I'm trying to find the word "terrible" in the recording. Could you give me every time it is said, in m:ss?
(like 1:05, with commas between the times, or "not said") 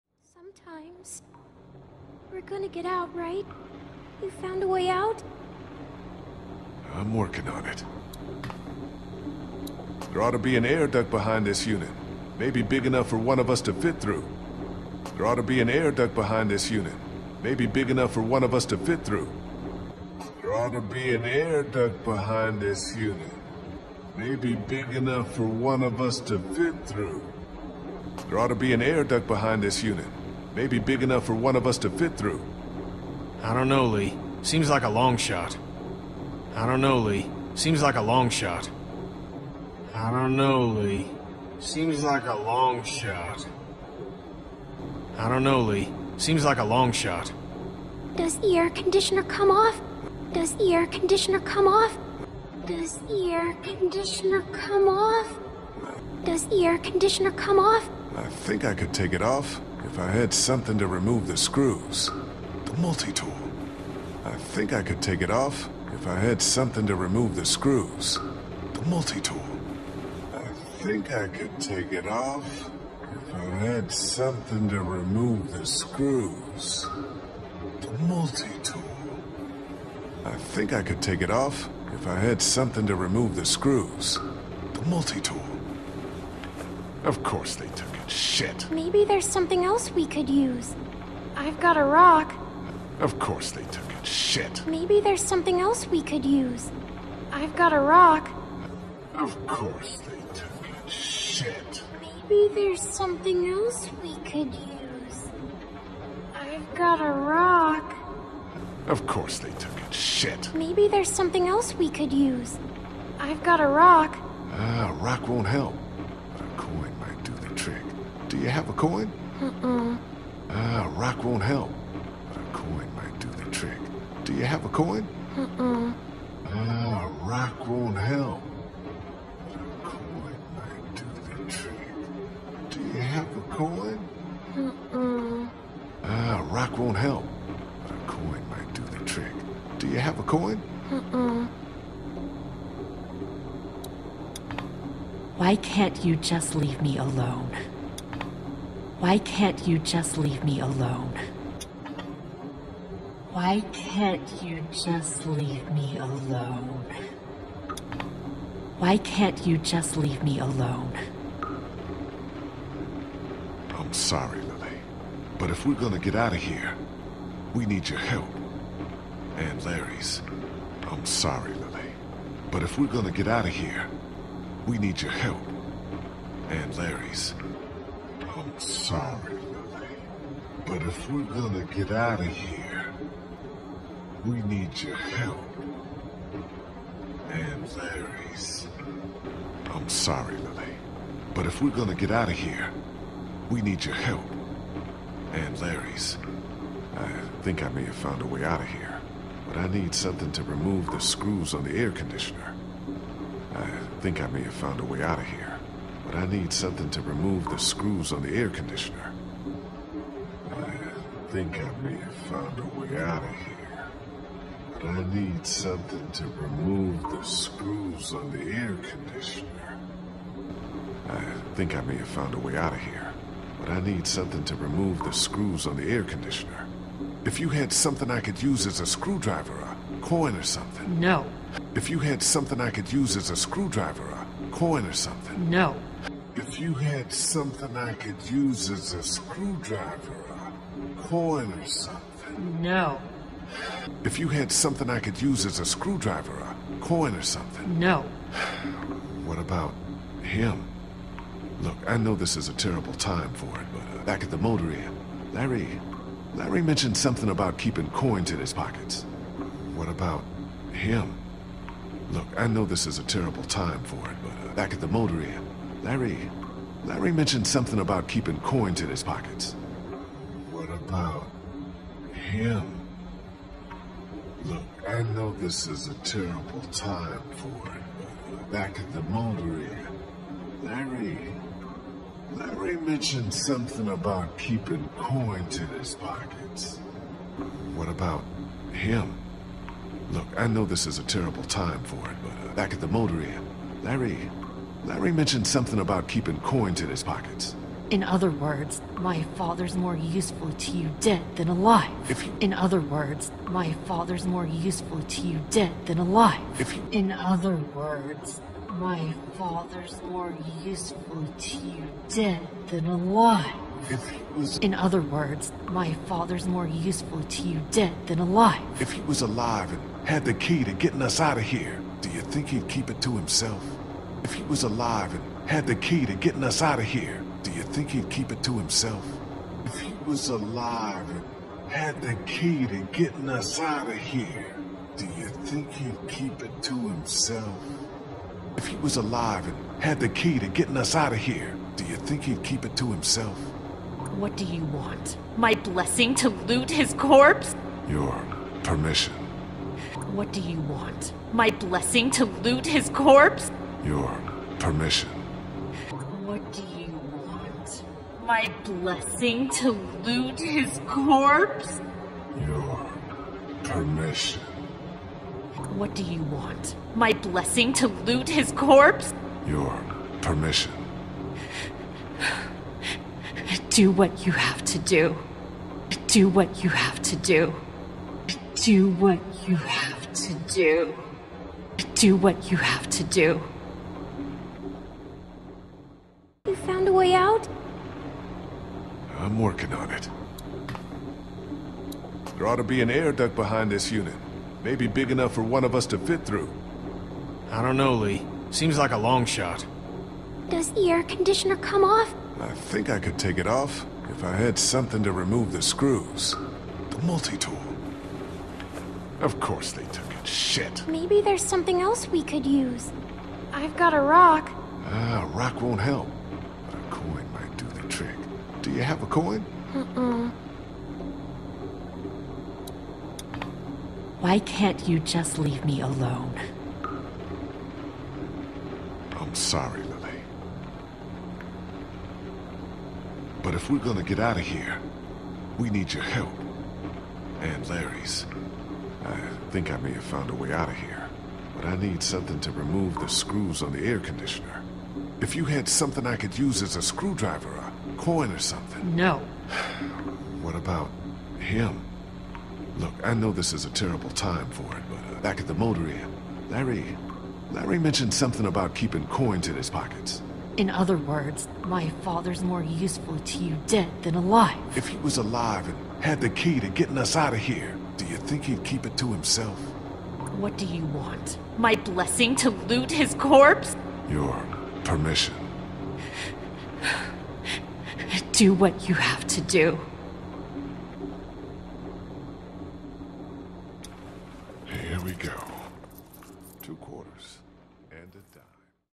4:12, 4:23, 4:36, 4:51, 7:33.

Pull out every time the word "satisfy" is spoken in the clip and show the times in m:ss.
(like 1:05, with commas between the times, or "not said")
not said.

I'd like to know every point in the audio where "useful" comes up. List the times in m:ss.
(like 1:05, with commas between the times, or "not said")
4:59, 5:04, 5:10, 5:16, 7:42.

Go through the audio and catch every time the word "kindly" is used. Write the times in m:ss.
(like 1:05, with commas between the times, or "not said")
not said.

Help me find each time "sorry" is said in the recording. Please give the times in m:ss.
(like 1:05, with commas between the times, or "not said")
2:43, 2:51, 2:58, 3:09, 7:09.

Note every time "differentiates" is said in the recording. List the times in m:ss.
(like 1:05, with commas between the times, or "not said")
not said.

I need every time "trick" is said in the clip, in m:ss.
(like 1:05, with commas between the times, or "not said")
2:03, 2:11, 2:19, 6:57.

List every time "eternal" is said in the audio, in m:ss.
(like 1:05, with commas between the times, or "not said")
not said.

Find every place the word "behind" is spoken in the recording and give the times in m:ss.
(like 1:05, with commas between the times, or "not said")
0:11, 0:16, 0:22, 0:29, 6:33.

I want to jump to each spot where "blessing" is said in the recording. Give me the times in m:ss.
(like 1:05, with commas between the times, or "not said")
5:45, 5:51, 5:58, 6:07, 7:51.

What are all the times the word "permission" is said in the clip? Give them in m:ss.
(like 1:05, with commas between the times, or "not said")
5:48, 5:54, 6:03, 6:10, 7:54.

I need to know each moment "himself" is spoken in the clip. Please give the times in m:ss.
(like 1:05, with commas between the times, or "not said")
5:23, 5:28, 5:36, 5:42, 7:49.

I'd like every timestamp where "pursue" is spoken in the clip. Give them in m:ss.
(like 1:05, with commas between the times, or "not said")
not said.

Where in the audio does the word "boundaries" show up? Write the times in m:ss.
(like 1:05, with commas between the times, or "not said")
not said.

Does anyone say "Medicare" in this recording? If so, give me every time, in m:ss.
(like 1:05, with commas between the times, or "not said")
not said.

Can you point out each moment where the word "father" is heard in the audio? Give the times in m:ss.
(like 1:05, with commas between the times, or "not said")
4:59, 5:03, 5:09, 5:16, 7:42.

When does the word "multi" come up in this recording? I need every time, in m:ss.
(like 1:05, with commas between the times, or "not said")
1:02, 1:08, 1:18, 1:24, 6:47.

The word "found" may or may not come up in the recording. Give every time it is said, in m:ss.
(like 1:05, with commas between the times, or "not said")
0:04, 3:17, 3:24, 3:32, 3:42, 7:20.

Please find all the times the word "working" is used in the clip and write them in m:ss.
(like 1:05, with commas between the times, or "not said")
0:07, 6:29.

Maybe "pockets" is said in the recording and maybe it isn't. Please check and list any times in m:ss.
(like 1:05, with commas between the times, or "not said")
4:18, 4:29, 4:45, 4:57, 7:39.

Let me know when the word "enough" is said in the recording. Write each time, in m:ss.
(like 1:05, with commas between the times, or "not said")
0:12, 0:17, 0:24, 0:31, 6:35.